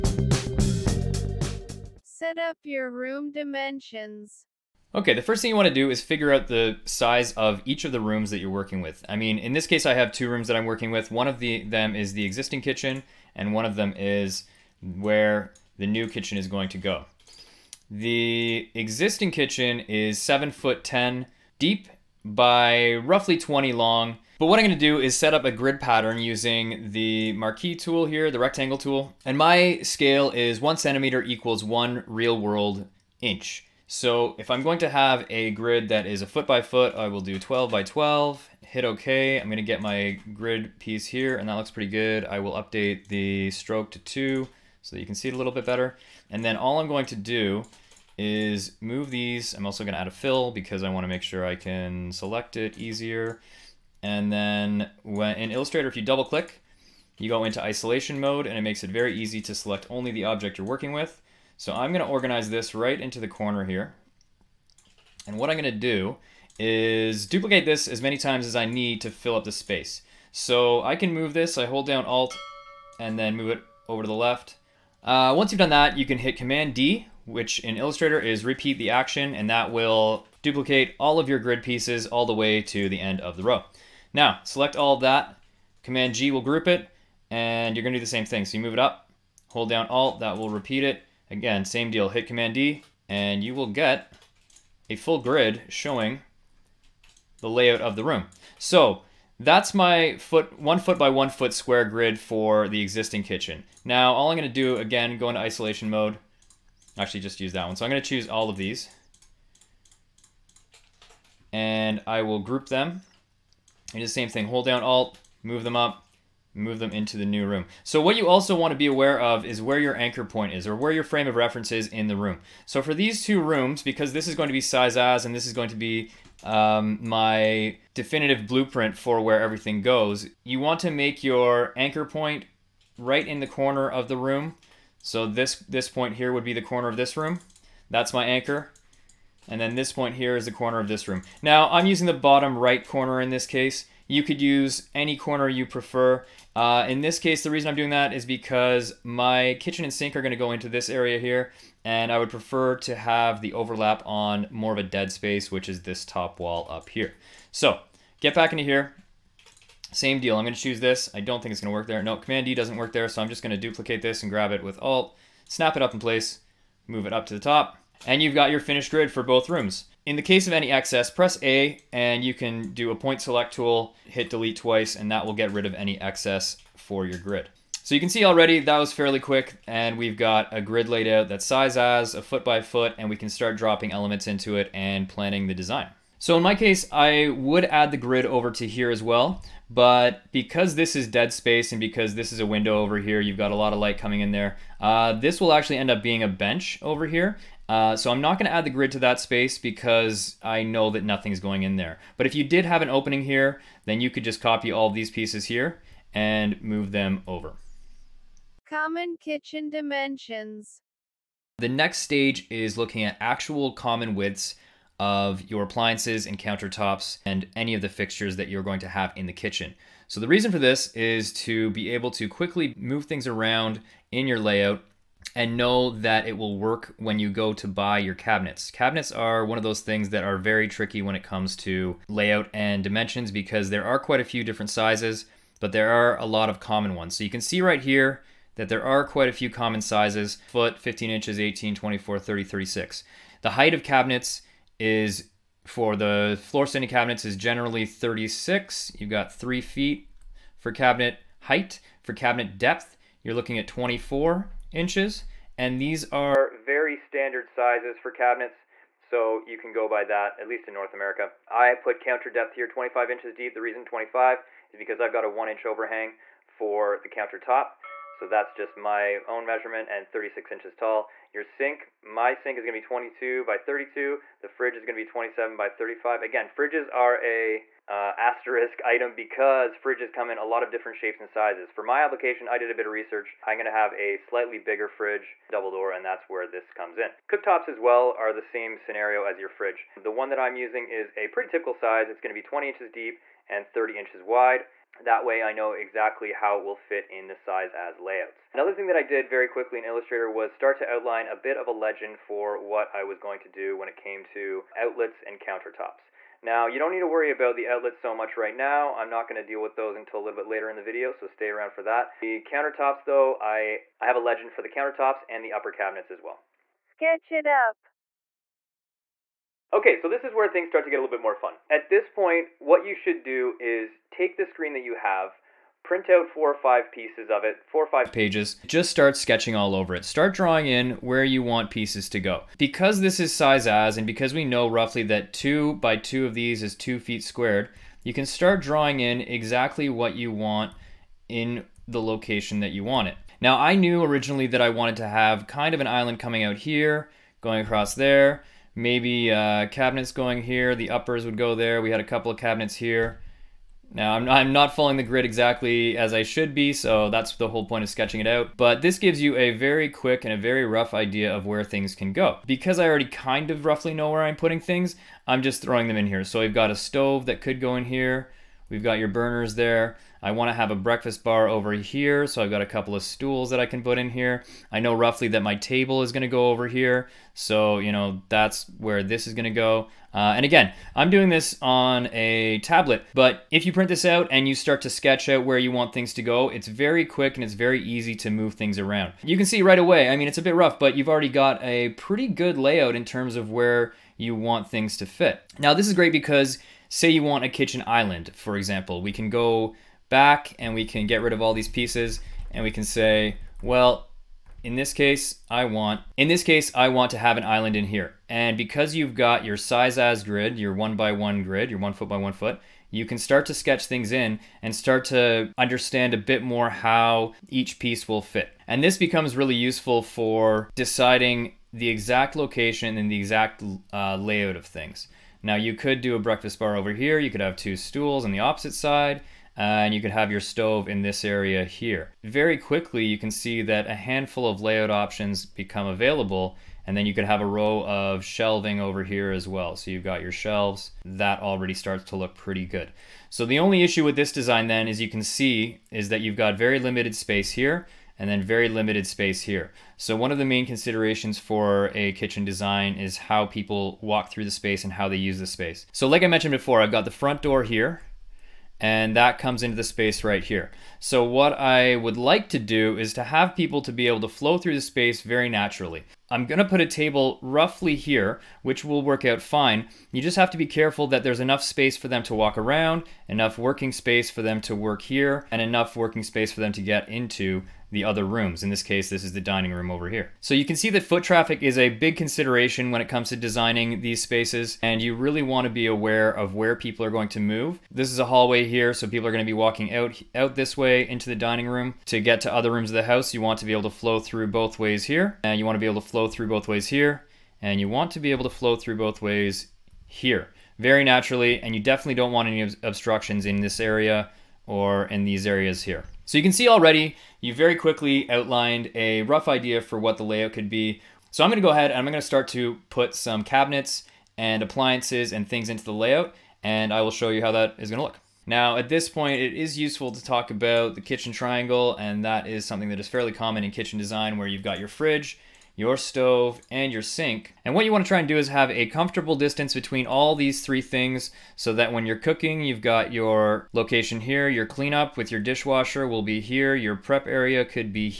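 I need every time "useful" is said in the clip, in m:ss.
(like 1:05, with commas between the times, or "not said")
6:59, 8:39.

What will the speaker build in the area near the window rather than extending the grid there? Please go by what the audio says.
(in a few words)
a bench.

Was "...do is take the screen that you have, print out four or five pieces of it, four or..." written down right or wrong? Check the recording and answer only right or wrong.
right.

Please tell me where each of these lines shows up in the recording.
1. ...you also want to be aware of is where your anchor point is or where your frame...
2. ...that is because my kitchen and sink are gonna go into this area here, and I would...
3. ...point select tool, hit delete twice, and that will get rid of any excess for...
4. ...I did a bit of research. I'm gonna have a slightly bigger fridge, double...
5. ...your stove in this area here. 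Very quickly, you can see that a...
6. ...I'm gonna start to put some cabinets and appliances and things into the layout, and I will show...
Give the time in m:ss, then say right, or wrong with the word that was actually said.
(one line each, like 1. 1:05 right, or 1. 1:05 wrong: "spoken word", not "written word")
1. 1:58 right
2. 2:27 right
3. 2:52 right
4. 4:42 right
5. 7:10 right
6. 8:31 right.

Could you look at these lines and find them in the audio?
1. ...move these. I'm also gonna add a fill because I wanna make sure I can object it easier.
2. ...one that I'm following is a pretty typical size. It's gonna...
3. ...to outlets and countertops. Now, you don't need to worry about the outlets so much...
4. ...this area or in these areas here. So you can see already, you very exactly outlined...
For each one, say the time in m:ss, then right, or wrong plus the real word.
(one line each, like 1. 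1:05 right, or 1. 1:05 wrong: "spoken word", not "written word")
1. 0:48 wrong: "select", not "object"
2. 4:50 wrong: "using", not "following"
3. 5:04 right
4. 8:23 wrong: "quickly", not "exactly".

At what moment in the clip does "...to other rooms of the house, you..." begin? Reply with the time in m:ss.
8:12.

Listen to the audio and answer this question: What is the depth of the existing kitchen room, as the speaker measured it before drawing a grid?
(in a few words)
7 foot 10.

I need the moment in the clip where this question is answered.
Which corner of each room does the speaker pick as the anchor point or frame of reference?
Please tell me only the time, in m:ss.
2:22.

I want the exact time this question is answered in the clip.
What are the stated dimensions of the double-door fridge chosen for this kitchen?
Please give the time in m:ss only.
4:35.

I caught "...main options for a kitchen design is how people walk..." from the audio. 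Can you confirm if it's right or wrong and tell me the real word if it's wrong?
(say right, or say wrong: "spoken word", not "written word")
wrong: "considerations", not "options".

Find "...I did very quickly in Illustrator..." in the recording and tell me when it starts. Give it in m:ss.
4:58.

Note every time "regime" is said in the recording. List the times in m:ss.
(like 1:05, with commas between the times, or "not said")
not said.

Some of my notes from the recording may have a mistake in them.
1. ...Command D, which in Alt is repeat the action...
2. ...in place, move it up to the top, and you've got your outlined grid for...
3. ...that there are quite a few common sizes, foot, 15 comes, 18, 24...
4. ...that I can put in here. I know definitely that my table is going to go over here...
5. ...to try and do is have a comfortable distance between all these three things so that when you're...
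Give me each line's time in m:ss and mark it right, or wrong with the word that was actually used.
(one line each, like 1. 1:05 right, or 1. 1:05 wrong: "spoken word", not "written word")
1. 1:16 wrong: "Illustrator", not "Alt"
2. 2:45 wrong: "finished", not "outlined"
3. 3:58 wrong: "inches", not "comes"
4. 6:13 wrong: "roughly", not "definitely"
5. 8:48 right.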